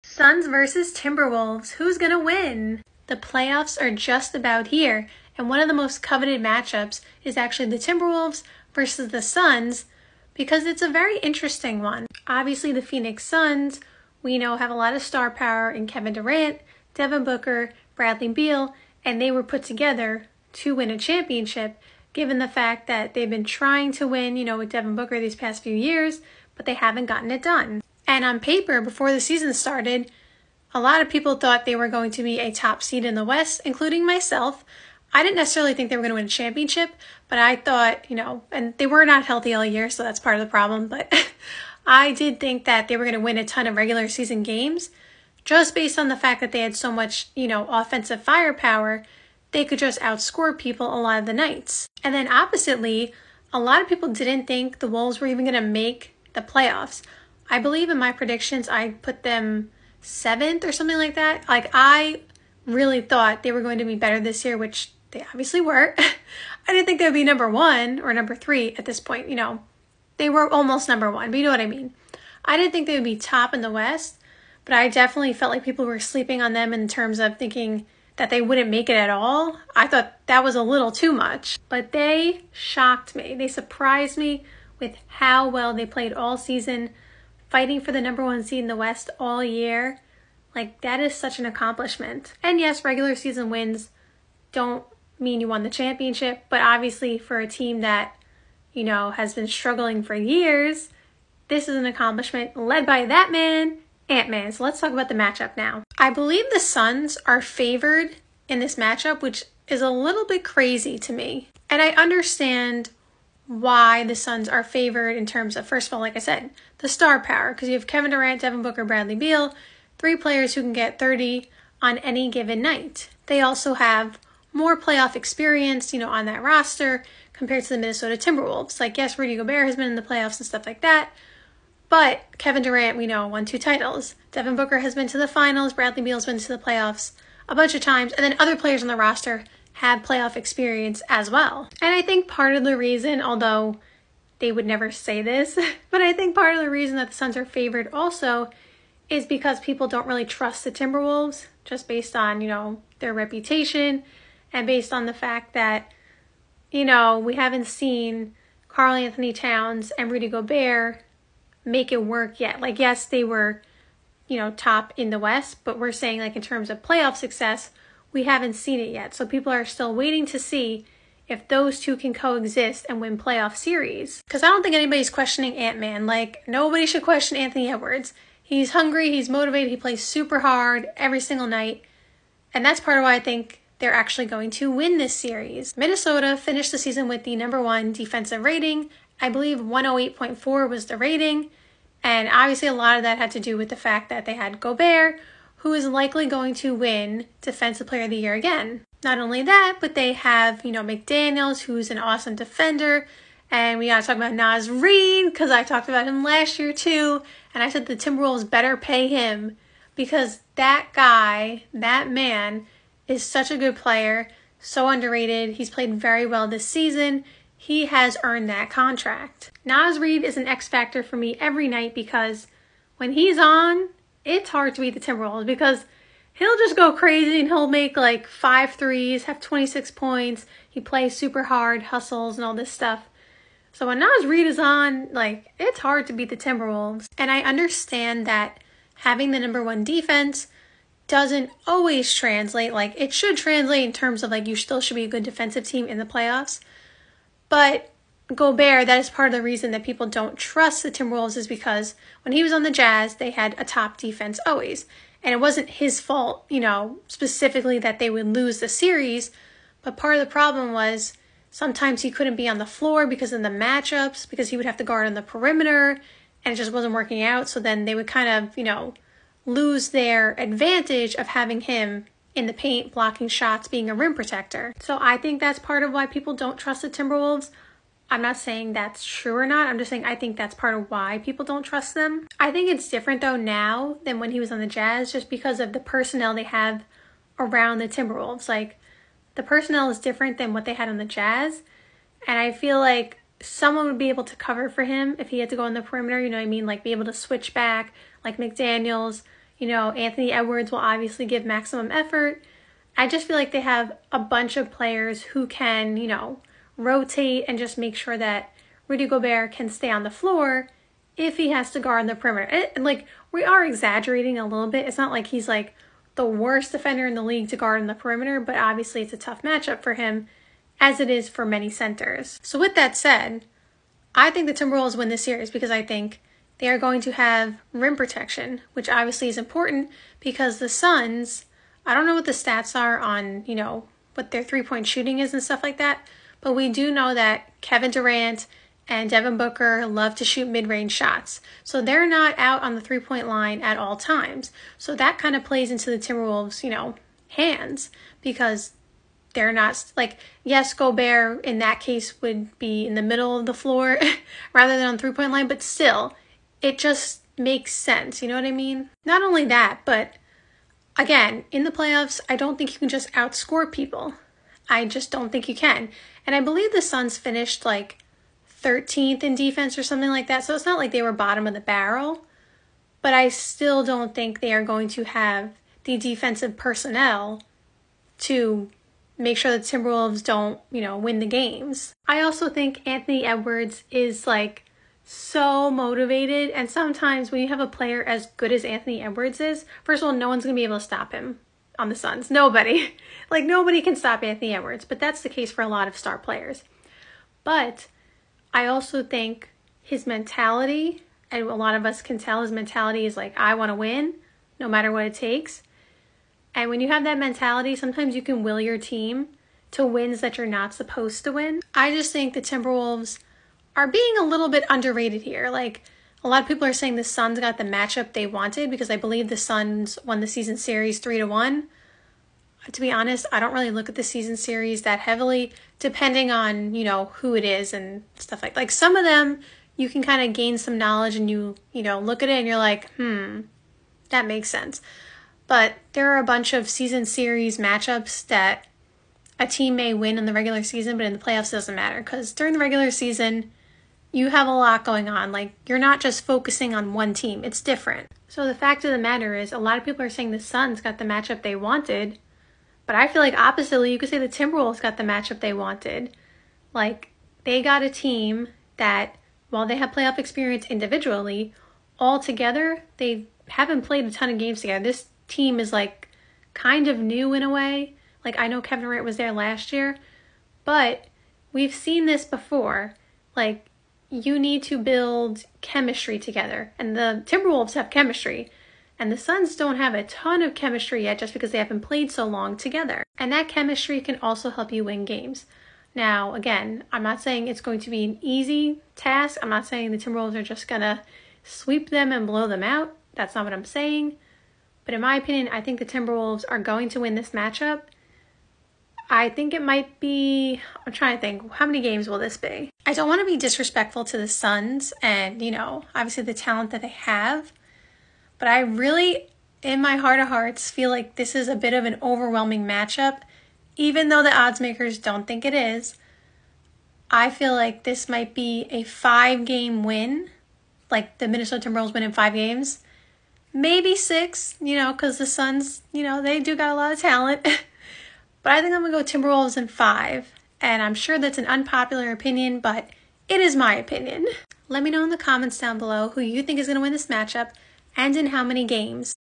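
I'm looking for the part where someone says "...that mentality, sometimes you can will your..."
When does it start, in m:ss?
6:47.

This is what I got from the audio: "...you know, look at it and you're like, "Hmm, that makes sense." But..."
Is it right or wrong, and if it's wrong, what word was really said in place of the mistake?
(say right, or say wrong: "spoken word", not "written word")
right.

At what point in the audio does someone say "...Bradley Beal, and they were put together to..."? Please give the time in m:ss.
0:17.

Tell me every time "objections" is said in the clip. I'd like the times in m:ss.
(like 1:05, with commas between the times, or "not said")
not said.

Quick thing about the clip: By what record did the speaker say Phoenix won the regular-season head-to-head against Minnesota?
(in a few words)
3-1.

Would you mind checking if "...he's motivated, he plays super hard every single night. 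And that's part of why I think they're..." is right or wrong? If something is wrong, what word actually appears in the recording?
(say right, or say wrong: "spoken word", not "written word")
right.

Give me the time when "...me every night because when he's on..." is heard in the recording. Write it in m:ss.
3:41.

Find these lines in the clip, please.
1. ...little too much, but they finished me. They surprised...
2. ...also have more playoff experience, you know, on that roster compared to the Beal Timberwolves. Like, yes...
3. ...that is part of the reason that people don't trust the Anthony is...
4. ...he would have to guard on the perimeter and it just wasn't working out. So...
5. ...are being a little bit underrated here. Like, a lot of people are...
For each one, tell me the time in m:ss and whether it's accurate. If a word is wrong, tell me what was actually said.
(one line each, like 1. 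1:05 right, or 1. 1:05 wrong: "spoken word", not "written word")
1. 1:20 wrong: "shocked", not "finished"
2. 2:03 wrong: "Minnesota", not "Beal"
3. 4:08 wrong: "Timberwolves", not "Anthony"
4. 4:24 right
5. 6:53 right.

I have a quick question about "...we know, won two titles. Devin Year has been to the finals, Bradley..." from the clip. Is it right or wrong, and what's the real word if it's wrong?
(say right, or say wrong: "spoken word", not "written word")
wrong: "Booker", not "Year".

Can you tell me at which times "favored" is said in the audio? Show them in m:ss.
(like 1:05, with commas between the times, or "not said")
1:47, 1:54, 2:27.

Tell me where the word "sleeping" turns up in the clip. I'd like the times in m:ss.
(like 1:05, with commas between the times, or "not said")
1:15.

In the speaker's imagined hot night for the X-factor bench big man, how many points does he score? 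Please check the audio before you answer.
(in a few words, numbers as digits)
26.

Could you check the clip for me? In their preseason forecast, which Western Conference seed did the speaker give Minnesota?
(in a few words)
7th.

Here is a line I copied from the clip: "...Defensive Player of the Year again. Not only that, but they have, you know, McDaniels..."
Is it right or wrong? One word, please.
right.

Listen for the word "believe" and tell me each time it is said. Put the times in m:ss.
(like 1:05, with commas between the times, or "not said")
0:57, 1:46, 3:09, 6:06, 6:58.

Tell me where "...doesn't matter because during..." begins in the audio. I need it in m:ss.
7:21.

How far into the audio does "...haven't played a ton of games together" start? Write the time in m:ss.
7:43.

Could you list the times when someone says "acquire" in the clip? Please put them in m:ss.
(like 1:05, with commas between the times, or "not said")
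not said.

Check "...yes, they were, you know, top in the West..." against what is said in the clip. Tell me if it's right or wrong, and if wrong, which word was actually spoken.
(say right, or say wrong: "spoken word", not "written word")
right.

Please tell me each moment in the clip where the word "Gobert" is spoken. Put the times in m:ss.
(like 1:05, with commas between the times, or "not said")
2:09, 2:40, 3:14, 4:08, 5:09, 5:50.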